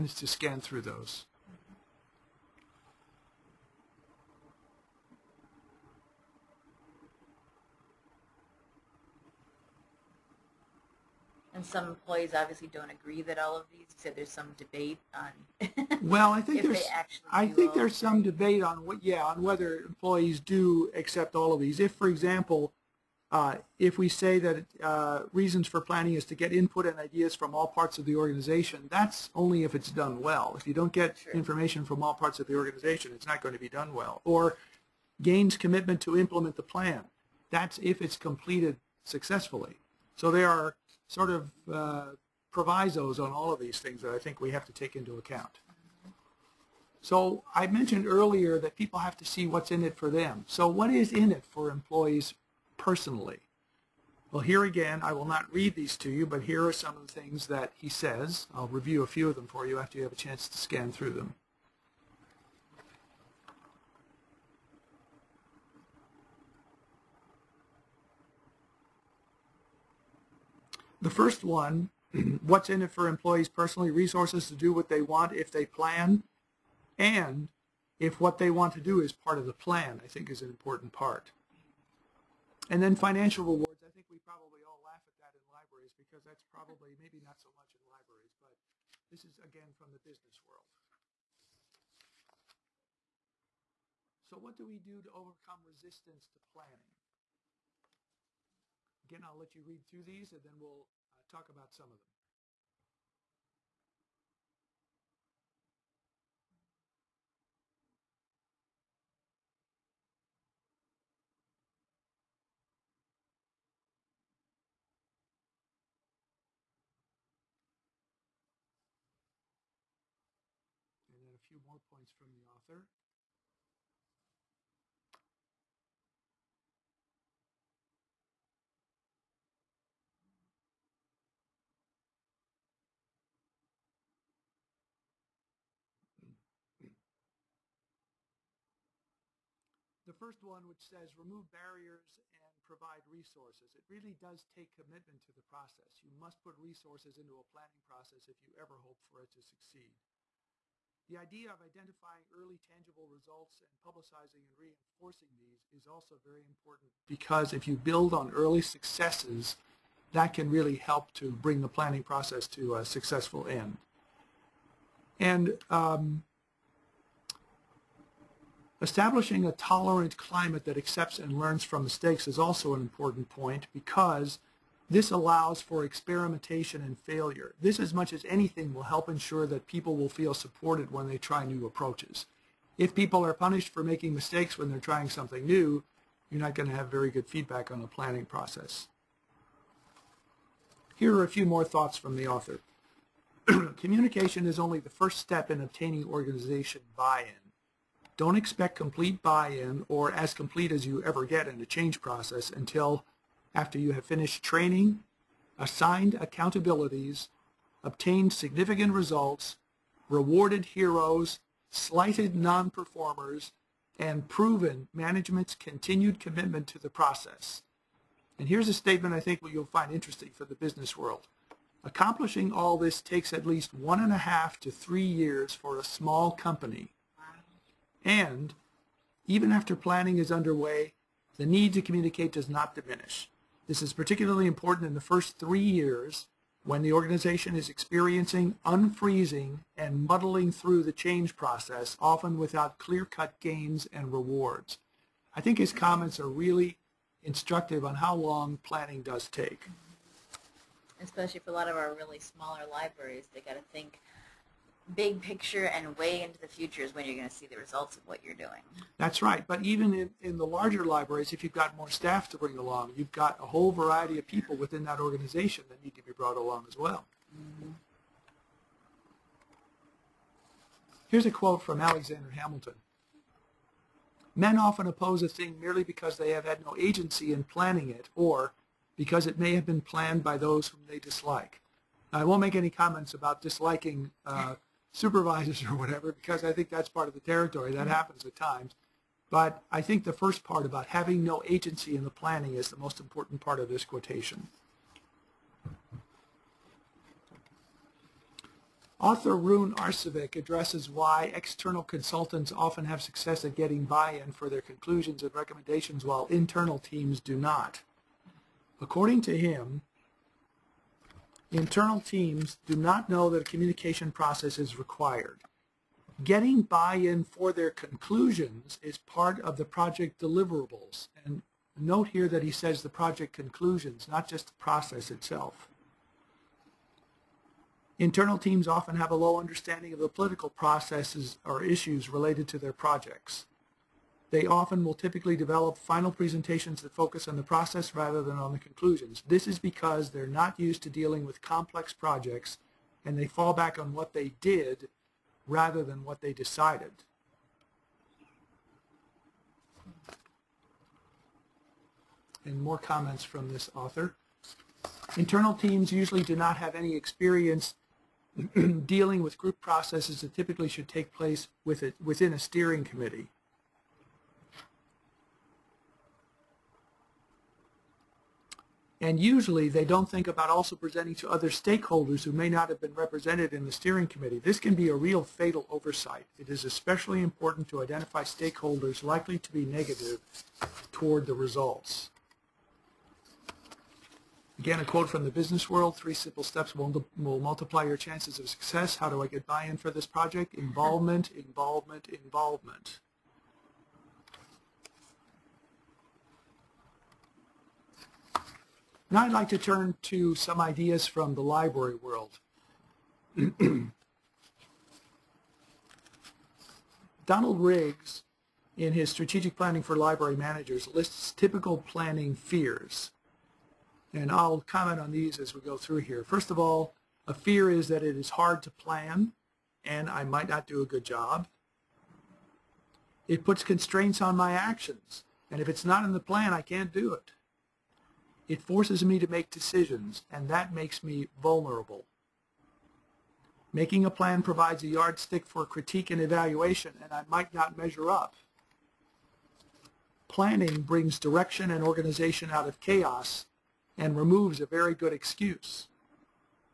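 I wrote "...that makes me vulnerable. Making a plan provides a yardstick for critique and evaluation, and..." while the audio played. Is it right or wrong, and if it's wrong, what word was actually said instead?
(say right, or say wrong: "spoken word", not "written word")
right.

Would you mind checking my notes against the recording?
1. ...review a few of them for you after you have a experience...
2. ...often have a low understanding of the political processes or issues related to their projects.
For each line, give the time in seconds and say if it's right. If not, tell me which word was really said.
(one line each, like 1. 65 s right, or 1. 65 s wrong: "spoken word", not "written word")
1. 58 s wrong: "chance", not "experience"
2. 328 s right.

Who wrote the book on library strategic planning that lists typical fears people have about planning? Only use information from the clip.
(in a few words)
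Donald Riggs.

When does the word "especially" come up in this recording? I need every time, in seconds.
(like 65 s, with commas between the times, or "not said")
251 s, 376 s.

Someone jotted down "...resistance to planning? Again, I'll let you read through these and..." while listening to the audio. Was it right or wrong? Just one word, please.
right.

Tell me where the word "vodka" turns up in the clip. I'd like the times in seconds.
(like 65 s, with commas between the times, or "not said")
not said.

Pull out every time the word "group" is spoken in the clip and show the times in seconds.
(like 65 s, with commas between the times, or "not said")
359 s.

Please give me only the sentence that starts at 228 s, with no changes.
And even after planning is underway, the need to communicate does not diminish.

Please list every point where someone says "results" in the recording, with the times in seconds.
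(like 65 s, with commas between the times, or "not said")
153 s, 208 s, 257 s, 381 s.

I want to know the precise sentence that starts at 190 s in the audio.
Here are a few more thoughts from the author.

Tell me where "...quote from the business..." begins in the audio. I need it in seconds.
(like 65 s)
384 s.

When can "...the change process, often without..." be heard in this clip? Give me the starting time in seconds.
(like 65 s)
240 s.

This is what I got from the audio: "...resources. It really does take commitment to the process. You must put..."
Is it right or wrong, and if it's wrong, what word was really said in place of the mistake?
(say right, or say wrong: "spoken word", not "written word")
right.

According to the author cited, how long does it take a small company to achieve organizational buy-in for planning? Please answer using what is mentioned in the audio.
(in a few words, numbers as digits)
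1.5 to 3 years.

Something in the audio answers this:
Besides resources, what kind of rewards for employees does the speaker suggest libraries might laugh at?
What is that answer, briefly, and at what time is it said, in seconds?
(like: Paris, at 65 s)
Financial rewards, at 82 s.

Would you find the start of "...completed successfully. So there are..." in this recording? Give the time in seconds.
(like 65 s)
38 s.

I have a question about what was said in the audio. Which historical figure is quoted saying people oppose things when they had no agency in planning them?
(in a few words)
Alexander Hamilton.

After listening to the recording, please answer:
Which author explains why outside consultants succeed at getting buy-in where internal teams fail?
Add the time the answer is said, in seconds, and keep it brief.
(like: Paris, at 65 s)
Rune Arcevic, at 299 s.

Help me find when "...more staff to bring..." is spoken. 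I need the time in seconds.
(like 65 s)
261 s.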